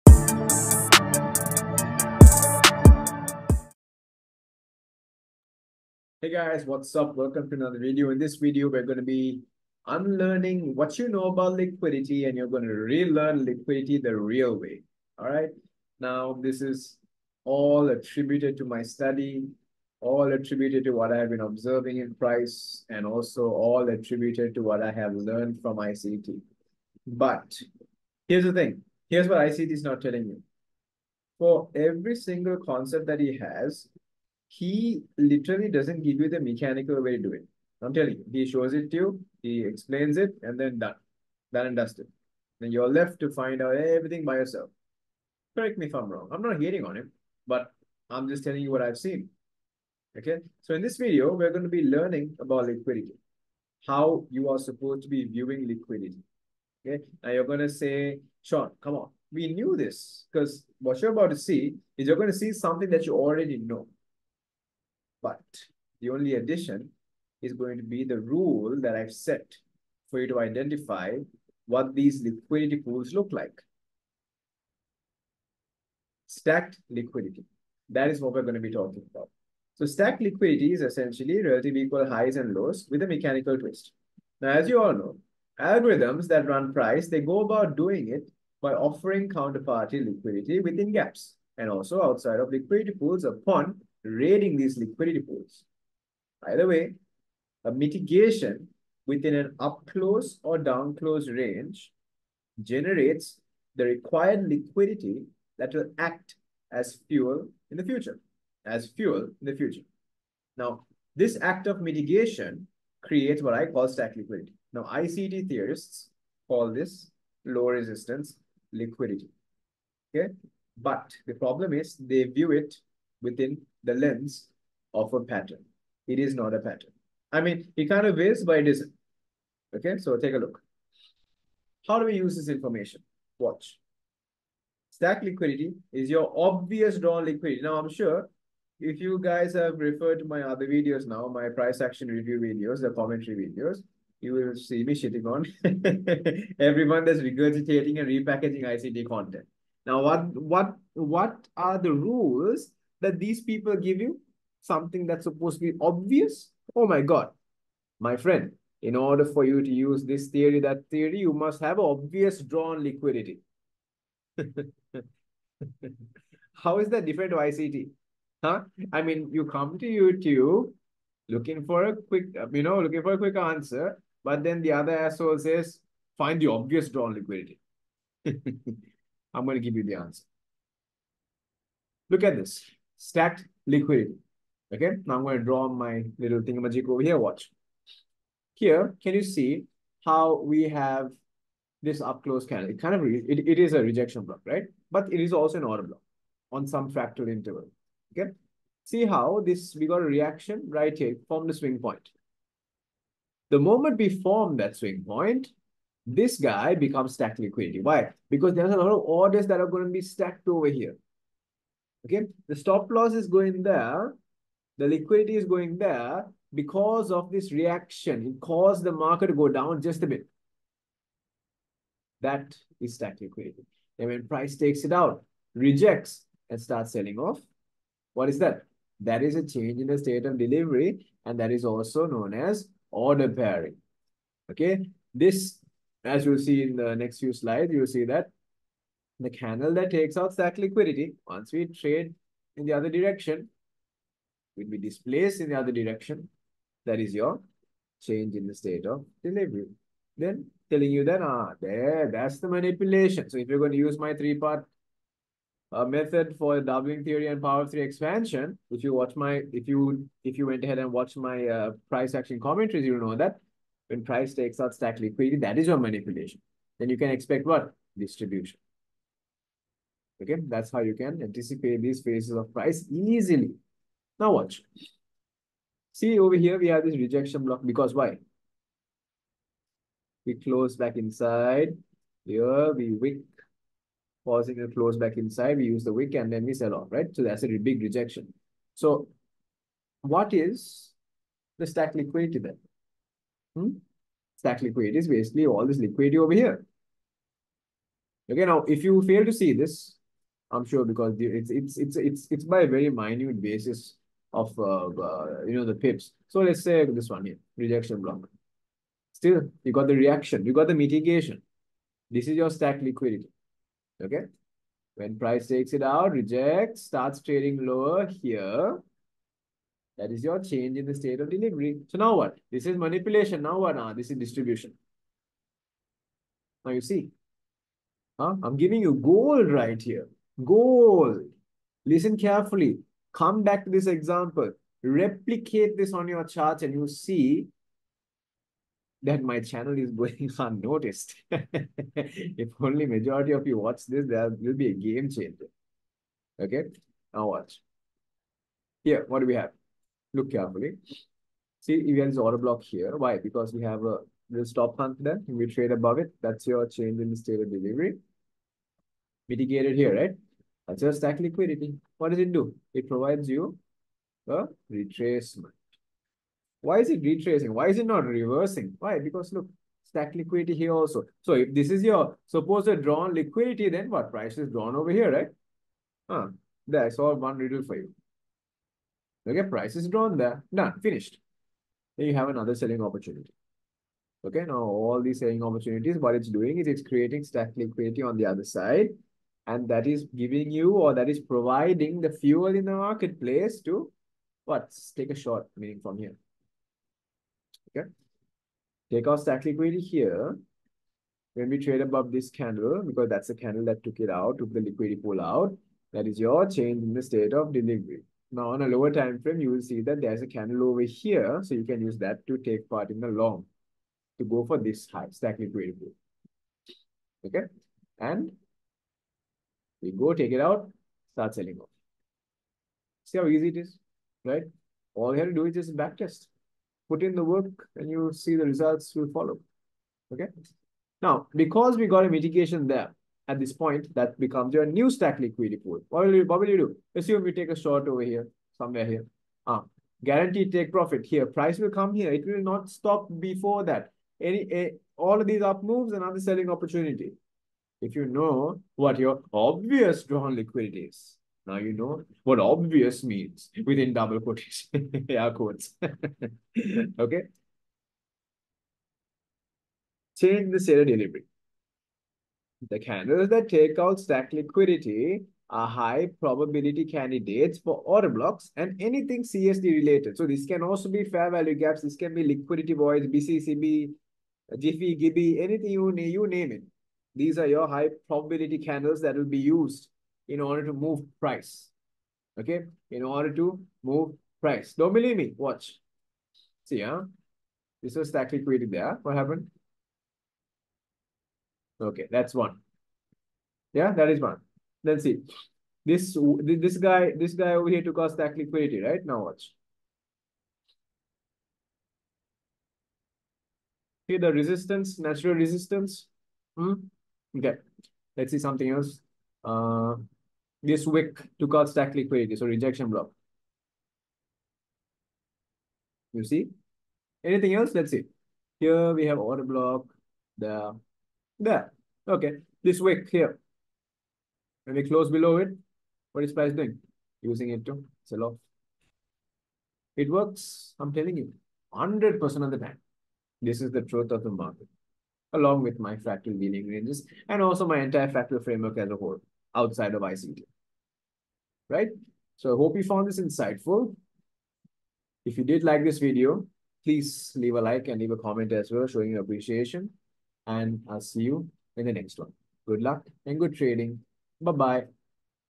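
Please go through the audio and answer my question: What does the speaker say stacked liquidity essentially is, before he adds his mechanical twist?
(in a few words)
relative equal highs and lows.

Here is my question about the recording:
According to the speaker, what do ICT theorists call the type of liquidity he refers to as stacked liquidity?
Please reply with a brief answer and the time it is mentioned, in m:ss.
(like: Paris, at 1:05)
low resistance liquidity, at 1:57.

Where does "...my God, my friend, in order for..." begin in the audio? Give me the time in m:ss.
2:36.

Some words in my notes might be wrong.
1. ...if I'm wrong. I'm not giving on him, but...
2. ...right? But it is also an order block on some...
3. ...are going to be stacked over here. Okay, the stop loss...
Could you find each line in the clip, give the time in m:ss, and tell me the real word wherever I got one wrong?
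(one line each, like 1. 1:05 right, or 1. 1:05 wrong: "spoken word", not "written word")
1. 0:45 wrong: "hating", not "giving"
2. 3:14 right
3. 3:29 right.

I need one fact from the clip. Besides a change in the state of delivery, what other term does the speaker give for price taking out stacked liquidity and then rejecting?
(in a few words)
order pairing.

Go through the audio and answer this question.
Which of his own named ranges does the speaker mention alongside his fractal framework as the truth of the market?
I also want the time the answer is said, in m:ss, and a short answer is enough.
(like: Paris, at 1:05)
fractal Wheeling ranges, at 8:55.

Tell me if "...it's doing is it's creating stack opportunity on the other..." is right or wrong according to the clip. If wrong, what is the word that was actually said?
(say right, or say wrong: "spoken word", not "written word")
wrong: "liquidity", not "opportunity".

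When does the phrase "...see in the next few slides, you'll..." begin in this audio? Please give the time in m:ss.
3:56.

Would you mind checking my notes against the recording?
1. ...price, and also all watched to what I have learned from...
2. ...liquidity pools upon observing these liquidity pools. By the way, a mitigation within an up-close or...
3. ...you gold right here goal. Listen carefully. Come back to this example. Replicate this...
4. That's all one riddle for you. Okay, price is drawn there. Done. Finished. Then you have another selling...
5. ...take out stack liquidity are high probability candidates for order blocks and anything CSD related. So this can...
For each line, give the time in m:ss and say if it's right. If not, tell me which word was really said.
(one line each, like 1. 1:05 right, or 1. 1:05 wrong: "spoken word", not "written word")
1. 0:22 wrong: "attributed", not "watched"
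2. 1:32 wrong: "raiding", not "observing"
3. 5:28 right
4. 6:16 right
5. 7:43 right.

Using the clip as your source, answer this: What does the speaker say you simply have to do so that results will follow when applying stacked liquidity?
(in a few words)
backtest.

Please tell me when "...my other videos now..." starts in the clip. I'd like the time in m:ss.
2:20.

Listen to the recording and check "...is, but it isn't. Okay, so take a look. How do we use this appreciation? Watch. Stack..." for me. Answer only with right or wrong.
wrong.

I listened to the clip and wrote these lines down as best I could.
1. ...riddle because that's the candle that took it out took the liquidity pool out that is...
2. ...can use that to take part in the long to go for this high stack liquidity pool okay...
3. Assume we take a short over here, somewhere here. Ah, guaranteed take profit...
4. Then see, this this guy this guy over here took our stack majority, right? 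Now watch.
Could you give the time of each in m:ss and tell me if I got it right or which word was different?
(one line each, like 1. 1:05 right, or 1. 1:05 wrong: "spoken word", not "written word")
1. 6:42 wrong: "candle", not "riddle"
2. 6:51 right
3. 7:16 right
4. 8:14 wrong: "liquidity", not "majority".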